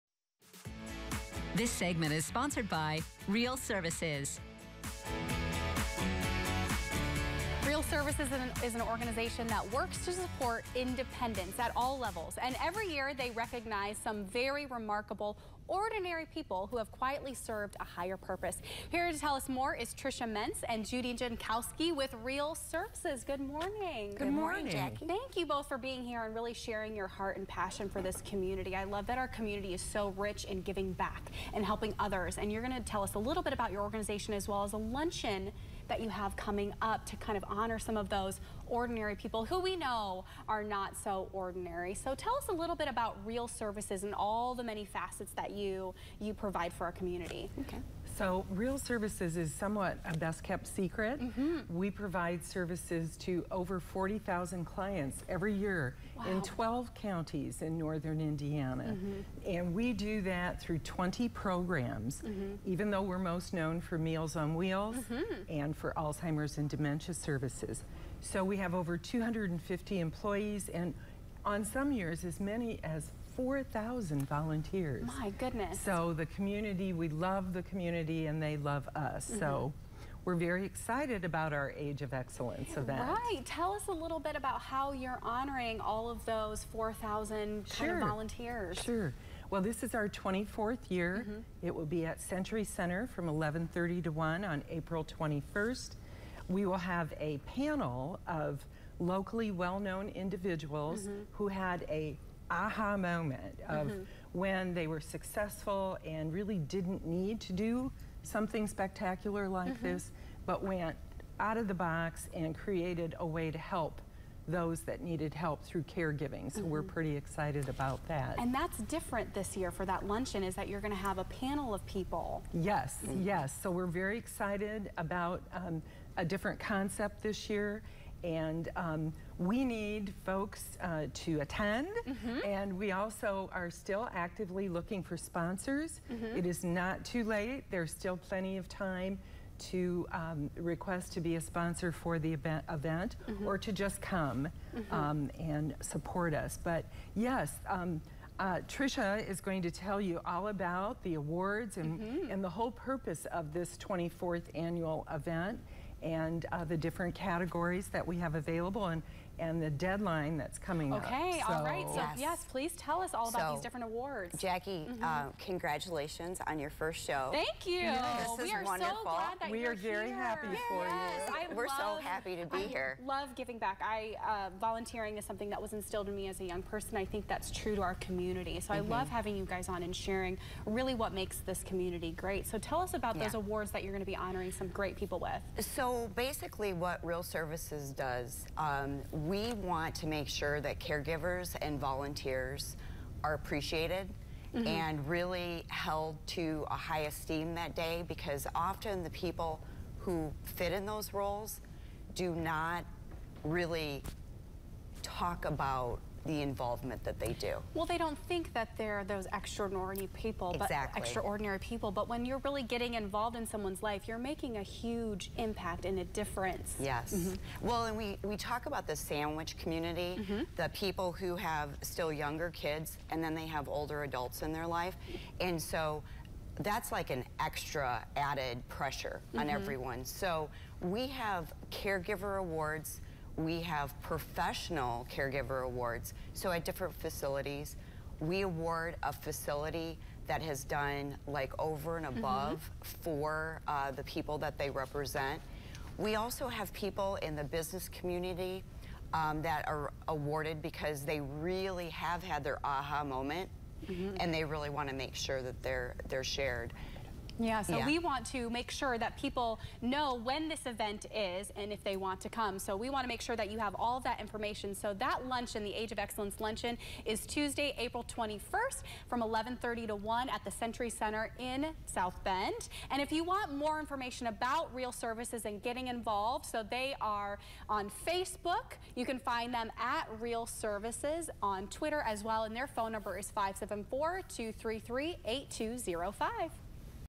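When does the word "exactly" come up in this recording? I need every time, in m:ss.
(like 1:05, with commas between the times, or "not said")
3:30.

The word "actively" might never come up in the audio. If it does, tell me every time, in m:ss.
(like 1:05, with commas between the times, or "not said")
2:14.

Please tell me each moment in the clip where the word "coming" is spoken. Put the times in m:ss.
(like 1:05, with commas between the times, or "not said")
0:36, 2:40.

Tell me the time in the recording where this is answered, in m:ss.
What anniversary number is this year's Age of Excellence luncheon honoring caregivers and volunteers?
1:30.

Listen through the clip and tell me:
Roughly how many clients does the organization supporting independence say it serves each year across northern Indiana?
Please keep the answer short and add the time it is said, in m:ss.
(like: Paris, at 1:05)
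over 40,000, at 0:53.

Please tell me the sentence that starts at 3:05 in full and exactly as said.
So so basically what Real Services does, um, we want to make sure that caregivers and volunteers are appreciated mm -hmm.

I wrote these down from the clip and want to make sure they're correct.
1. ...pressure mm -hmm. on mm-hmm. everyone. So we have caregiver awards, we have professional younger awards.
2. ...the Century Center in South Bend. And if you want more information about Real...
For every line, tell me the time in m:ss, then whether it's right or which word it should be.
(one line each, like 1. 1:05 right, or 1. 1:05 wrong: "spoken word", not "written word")
1. 3:48 wrong: "caregiver", not "younger"
2. 4:30 right.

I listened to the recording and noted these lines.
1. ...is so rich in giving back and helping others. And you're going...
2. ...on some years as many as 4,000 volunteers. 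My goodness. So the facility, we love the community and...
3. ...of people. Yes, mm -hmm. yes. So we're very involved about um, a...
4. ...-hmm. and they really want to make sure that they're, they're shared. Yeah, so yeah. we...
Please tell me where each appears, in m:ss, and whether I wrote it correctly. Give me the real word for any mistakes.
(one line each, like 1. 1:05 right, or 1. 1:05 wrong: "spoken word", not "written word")
1. 0:29 right
2. 1:11 wrong: "community", not "facility"
3. 2:01 wrong: "excited", not "involved"
4. 4:13 right.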